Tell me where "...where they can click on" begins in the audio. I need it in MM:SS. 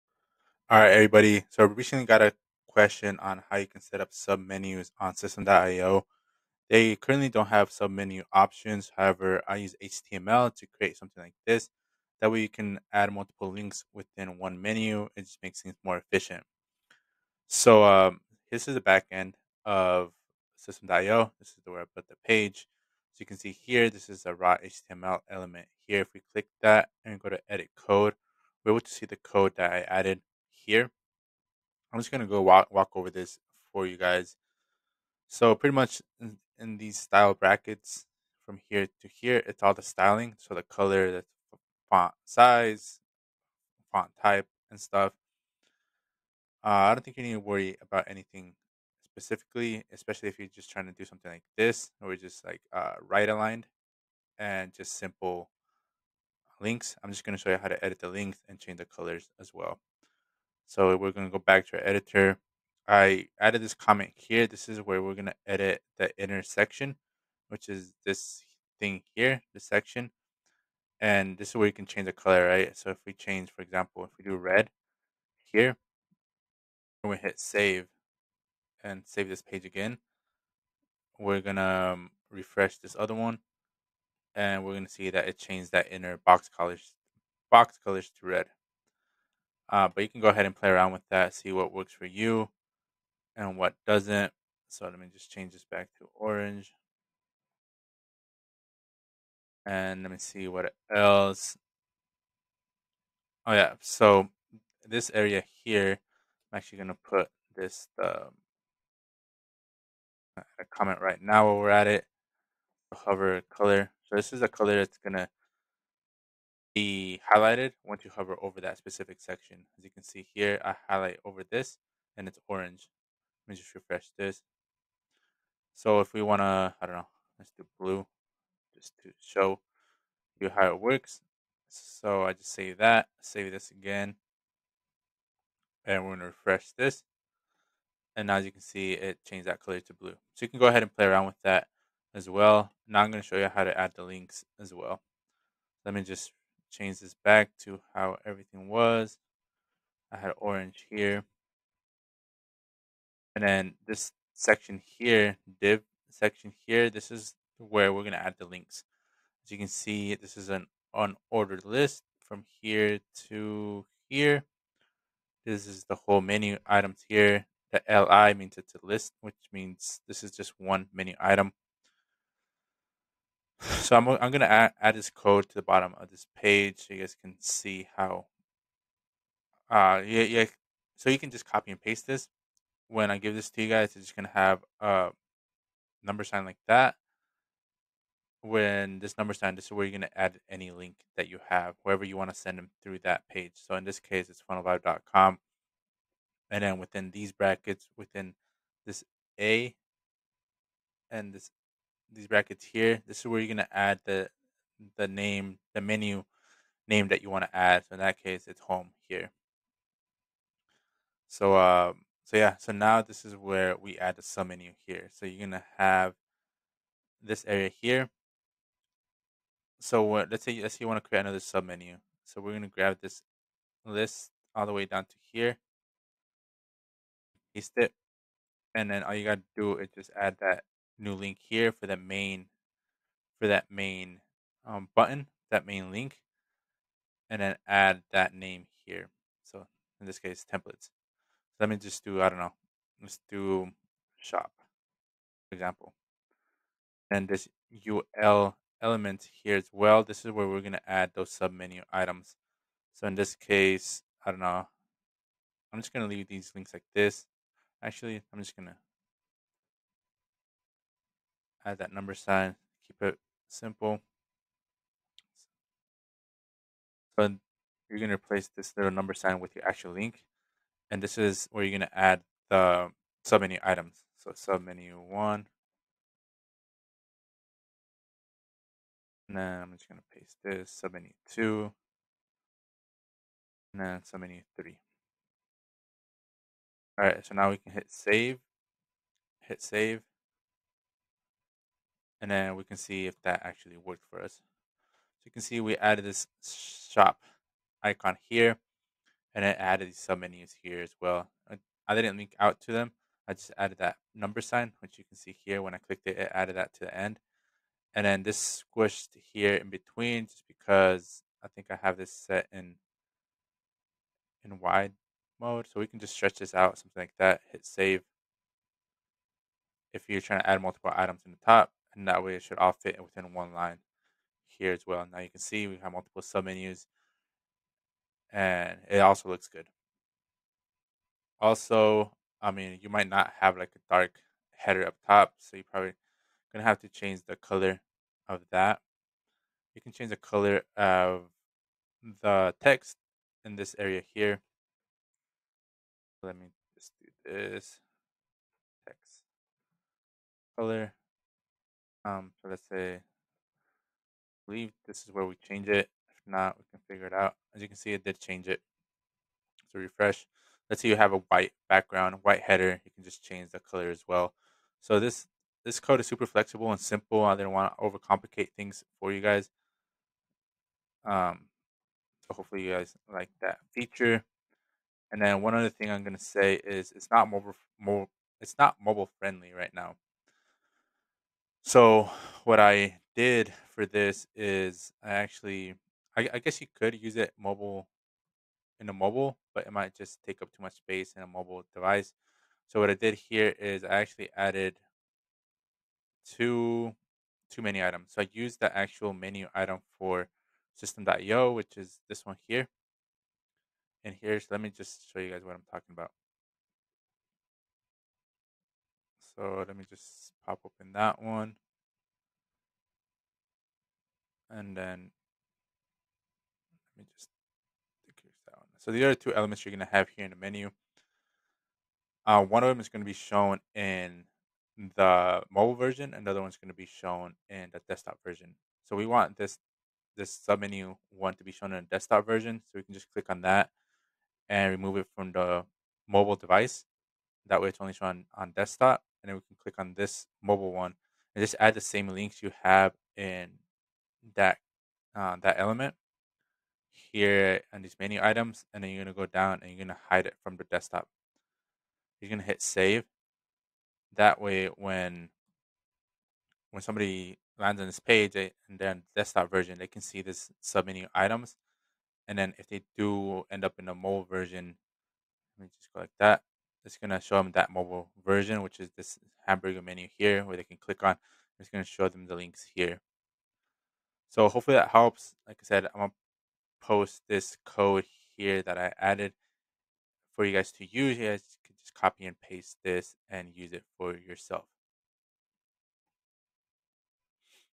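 07:50.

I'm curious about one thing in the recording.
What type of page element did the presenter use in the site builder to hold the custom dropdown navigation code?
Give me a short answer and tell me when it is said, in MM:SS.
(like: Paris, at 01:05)
Raw HTML element, at 00:24.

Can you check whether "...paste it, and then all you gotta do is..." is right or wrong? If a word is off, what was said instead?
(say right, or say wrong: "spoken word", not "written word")
right.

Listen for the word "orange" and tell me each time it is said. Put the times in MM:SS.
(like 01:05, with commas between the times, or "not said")
01:36, 02:02, 02:30.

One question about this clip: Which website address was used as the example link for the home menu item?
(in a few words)
funnelvibe.com.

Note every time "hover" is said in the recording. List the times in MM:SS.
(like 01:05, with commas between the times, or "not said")
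01:52, 01:58.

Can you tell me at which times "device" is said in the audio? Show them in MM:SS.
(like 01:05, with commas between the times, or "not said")
06:31, 07:16.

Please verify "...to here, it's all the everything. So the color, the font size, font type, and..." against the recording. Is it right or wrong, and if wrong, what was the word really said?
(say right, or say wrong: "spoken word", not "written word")
wrong: "styling", not "everything".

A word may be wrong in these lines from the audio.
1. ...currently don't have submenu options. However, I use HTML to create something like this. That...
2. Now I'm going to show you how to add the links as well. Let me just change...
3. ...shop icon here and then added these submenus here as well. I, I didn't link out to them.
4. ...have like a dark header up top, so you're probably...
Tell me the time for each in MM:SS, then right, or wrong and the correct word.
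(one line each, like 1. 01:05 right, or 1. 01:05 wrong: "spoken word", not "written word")
1. 00:06 right
2. 02:22 right
3. 04:56 right
4. 05:33 right.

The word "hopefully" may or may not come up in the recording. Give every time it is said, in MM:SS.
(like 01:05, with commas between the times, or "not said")
06:12, 07:54.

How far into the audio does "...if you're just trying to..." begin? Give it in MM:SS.
00:50.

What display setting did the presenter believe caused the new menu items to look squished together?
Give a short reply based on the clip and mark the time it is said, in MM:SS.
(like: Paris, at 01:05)
Wide mode, at 05:14.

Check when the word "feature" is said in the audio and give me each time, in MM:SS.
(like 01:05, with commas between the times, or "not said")
06:13.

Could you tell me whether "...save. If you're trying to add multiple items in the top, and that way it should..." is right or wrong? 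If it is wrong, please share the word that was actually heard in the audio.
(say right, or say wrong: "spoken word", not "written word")
right.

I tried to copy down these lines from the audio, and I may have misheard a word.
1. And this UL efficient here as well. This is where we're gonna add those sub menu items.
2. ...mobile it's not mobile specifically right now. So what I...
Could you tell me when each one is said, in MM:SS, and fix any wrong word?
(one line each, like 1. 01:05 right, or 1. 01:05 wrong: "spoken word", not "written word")
1. 04:07 wrong: "element", not "efficient"
2. 06:17 wrong: "friendly", not "specifically".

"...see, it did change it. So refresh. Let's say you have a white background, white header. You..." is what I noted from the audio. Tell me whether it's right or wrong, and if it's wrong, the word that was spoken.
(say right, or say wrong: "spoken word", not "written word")
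right.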